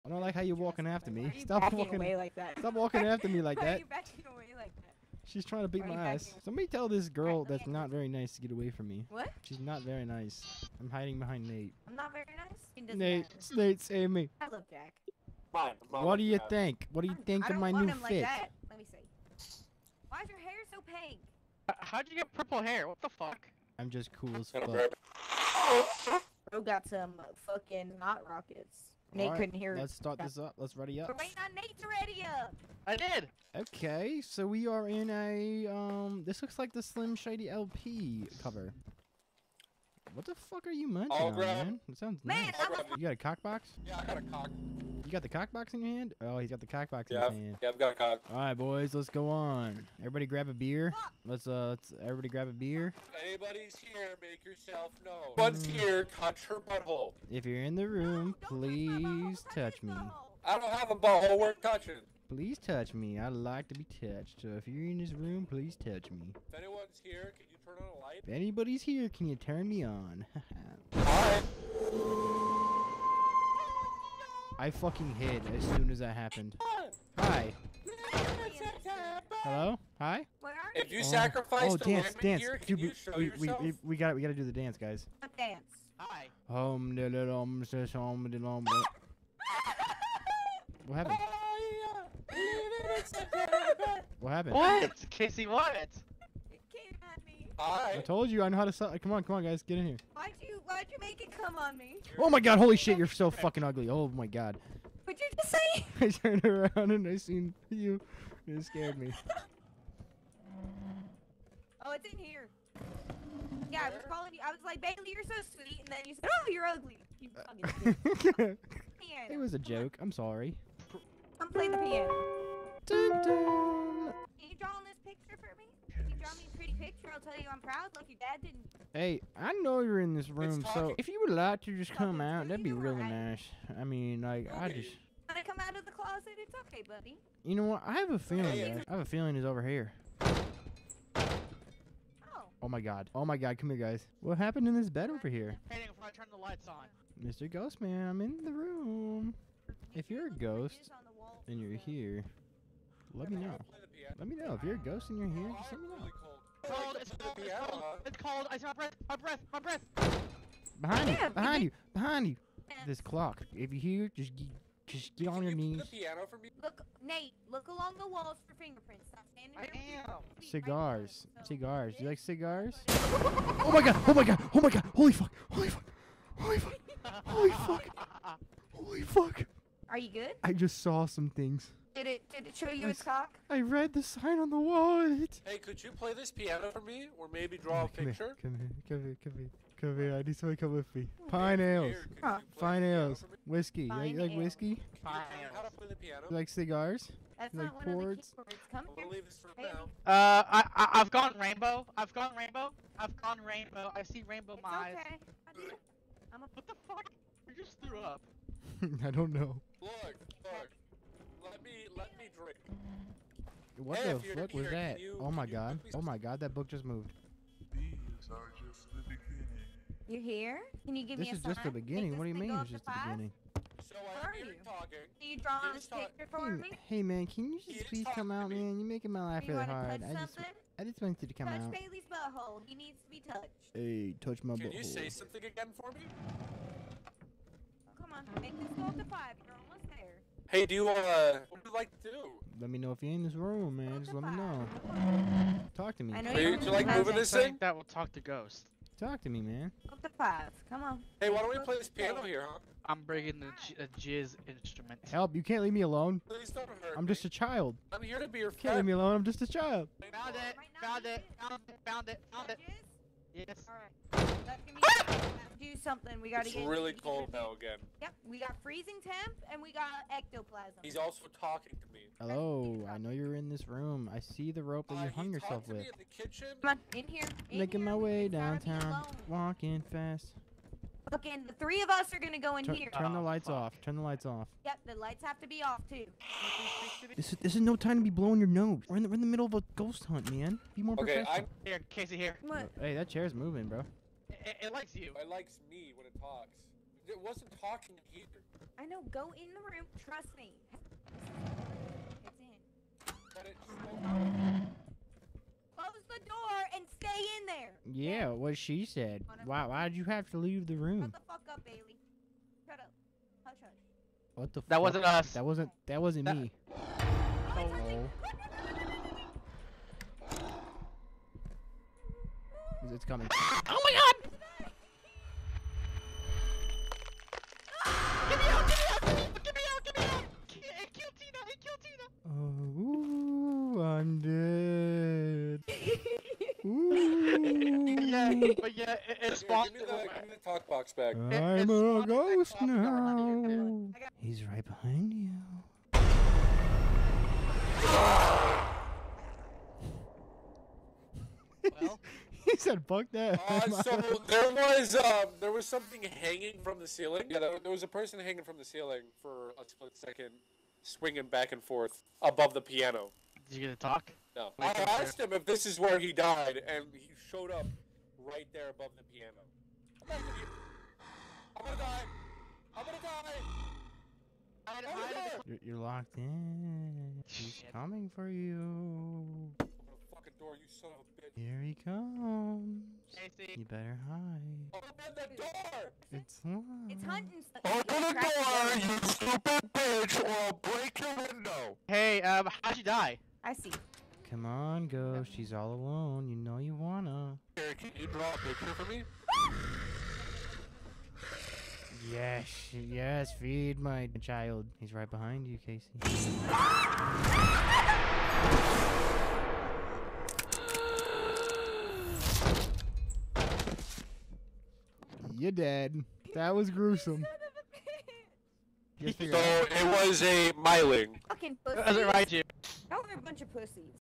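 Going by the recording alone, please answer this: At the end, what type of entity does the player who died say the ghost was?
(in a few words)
A miling.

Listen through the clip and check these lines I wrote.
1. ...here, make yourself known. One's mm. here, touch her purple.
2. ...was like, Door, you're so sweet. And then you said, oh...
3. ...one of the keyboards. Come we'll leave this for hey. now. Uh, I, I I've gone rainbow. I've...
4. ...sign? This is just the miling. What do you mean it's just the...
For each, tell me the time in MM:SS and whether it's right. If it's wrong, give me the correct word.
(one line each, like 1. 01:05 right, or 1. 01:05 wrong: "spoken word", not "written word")
1. 00:53 wrong: "butthole", not "purple"
2. 01:54 wrong: "Bailey", not "Door"
3. 03:17 right
4. 03:41 wrong: "beginning", not "miling".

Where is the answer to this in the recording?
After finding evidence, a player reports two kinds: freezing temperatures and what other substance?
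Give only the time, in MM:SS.
04:30.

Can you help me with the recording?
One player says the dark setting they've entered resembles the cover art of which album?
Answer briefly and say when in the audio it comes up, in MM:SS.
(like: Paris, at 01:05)
The Slim Shady LP, at 00:36.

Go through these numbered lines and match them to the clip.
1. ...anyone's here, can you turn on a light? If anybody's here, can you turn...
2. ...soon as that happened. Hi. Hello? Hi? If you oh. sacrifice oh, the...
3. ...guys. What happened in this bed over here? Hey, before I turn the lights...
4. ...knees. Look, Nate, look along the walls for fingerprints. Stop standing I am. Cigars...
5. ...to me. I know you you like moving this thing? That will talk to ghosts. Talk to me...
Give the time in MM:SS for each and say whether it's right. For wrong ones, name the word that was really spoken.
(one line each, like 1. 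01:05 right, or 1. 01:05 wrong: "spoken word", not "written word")
1. 01:06 right
2. 01:15 right
3. 02:23 right
4. 02:45 right
5. 04:05 right.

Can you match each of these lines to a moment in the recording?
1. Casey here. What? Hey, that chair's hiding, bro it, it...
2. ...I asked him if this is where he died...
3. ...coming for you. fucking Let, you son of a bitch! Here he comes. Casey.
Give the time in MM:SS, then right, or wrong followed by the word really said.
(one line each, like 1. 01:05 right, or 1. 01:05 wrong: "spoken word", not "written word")
1. 04:51 wrong: "moving", not "hiding"
2. 06:04 right
3. 06:17 wrong: "Door", not "Let".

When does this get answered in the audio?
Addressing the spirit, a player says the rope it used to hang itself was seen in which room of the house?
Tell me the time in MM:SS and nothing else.
04:36.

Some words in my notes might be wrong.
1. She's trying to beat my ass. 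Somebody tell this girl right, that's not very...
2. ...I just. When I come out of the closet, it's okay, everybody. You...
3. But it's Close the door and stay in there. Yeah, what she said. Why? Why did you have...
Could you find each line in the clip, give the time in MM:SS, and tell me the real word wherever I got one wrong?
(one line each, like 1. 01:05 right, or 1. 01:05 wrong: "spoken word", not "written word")
1. 00:05 right
2. 02:14 wrong: "buddy", not "everybody"
3. 05:03 right.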